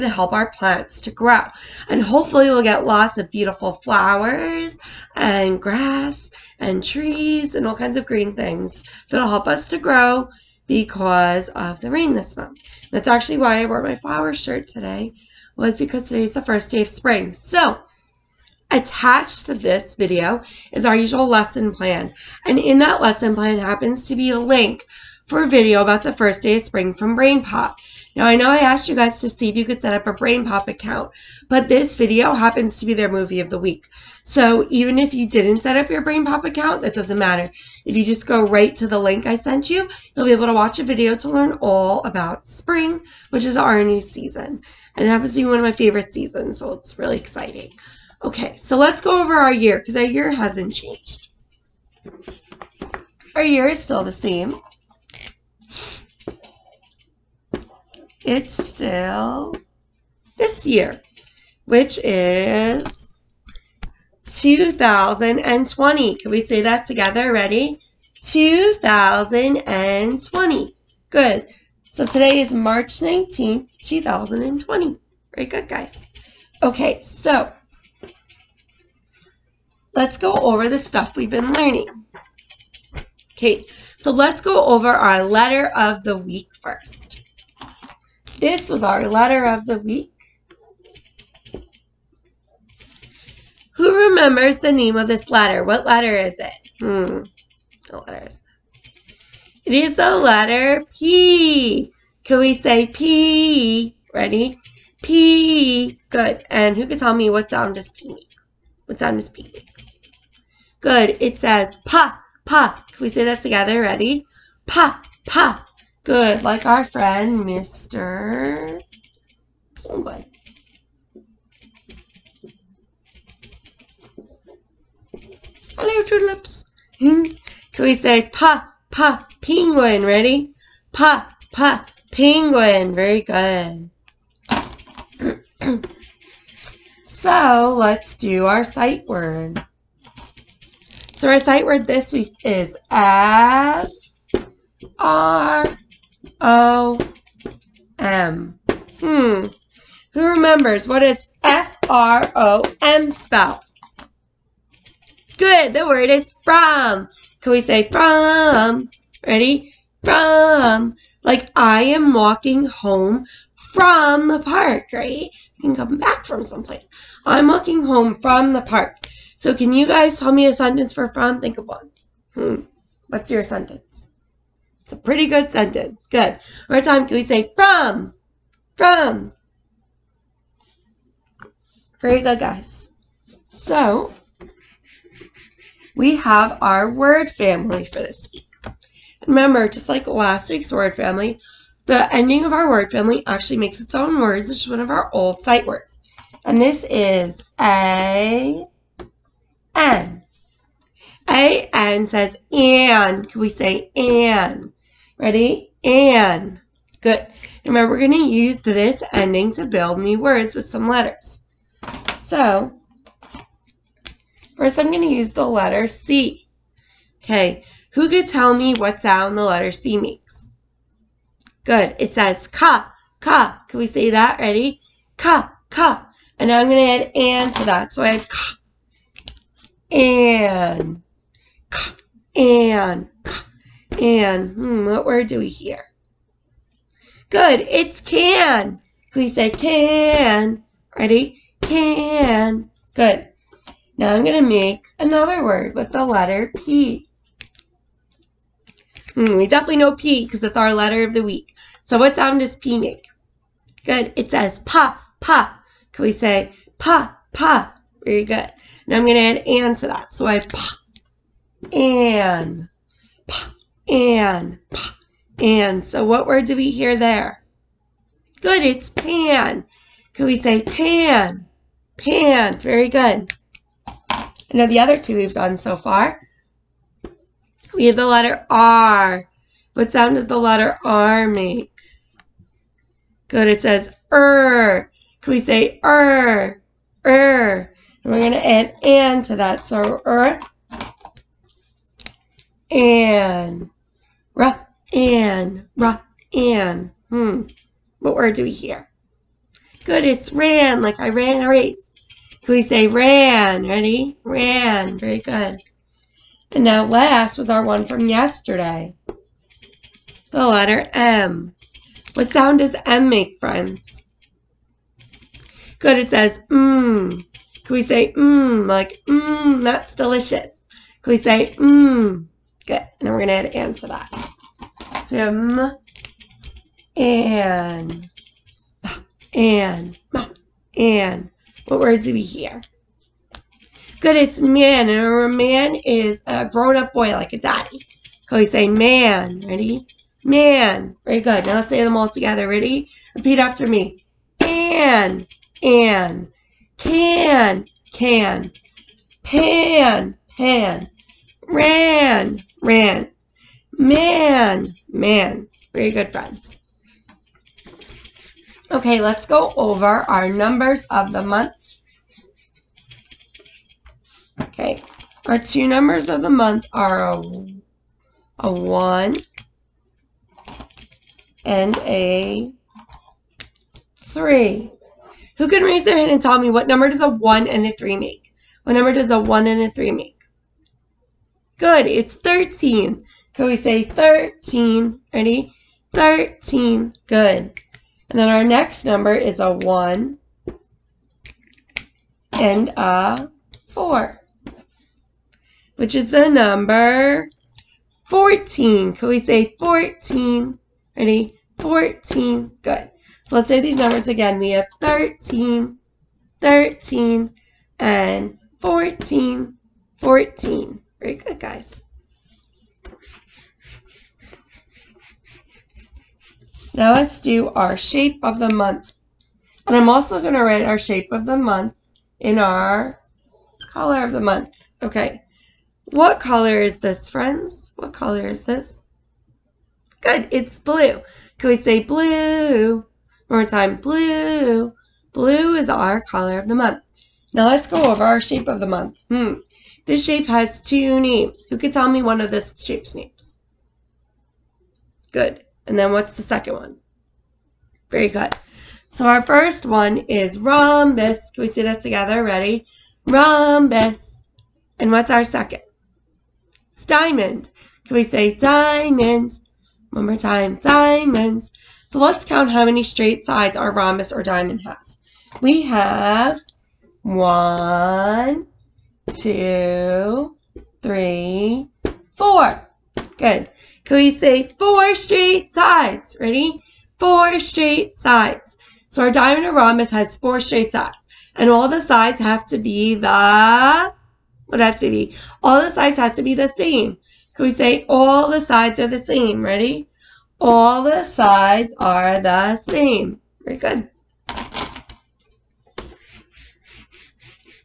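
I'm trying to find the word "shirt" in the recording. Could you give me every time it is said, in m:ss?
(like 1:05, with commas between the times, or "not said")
0:14.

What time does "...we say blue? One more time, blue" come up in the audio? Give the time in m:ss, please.
7:11.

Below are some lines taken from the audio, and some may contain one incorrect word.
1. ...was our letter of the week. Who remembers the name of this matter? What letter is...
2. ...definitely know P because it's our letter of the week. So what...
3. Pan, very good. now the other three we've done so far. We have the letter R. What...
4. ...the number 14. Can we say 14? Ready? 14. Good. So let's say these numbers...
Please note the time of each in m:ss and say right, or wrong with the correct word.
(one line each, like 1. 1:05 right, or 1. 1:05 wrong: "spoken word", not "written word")
1. 1:28 wrong: "letter", not "matter"
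2. 4:09 right
3. 4:31 wrong: "two", not "three"
4. 6:36 right.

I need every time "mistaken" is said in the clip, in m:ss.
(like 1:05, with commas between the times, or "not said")
not said.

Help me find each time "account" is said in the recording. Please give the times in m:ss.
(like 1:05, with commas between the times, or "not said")
0:30, 0:36.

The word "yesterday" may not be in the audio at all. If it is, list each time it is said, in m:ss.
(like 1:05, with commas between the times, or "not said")
5:08.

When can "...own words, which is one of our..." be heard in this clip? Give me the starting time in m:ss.
3:13.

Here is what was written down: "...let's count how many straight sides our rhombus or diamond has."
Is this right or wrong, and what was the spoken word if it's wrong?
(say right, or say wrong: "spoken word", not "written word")
right.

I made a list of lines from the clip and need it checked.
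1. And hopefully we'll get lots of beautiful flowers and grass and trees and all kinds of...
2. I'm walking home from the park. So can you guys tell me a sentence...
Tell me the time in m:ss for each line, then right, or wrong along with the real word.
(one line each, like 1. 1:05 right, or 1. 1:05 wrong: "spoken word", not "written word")
1. 0:01 right
2. 2:47 right.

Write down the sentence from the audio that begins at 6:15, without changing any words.
Who can raise their hand and tell me what number does a 1 and a 3 make?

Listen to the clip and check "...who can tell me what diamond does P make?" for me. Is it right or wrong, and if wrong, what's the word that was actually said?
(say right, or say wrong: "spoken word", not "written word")
wrong: "sound", not "diamond".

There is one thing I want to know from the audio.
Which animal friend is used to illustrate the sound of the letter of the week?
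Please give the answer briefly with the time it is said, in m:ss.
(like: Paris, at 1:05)
Mr. Penguin, at 1:57.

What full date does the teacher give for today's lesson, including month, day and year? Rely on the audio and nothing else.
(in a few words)
March 19th, 2020.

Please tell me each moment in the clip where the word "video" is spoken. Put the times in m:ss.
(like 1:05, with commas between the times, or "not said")
0:19, 0:25, 0:31, 0:40.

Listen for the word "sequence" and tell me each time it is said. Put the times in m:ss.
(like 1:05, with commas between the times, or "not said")
not said.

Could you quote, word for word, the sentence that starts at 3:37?
Okay, who could tell me what sound the letter C makes?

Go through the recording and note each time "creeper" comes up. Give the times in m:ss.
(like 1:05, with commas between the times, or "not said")
not said.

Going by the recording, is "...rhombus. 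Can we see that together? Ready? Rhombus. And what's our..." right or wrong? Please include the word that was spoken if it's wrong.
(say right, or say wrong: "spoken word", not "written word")
right.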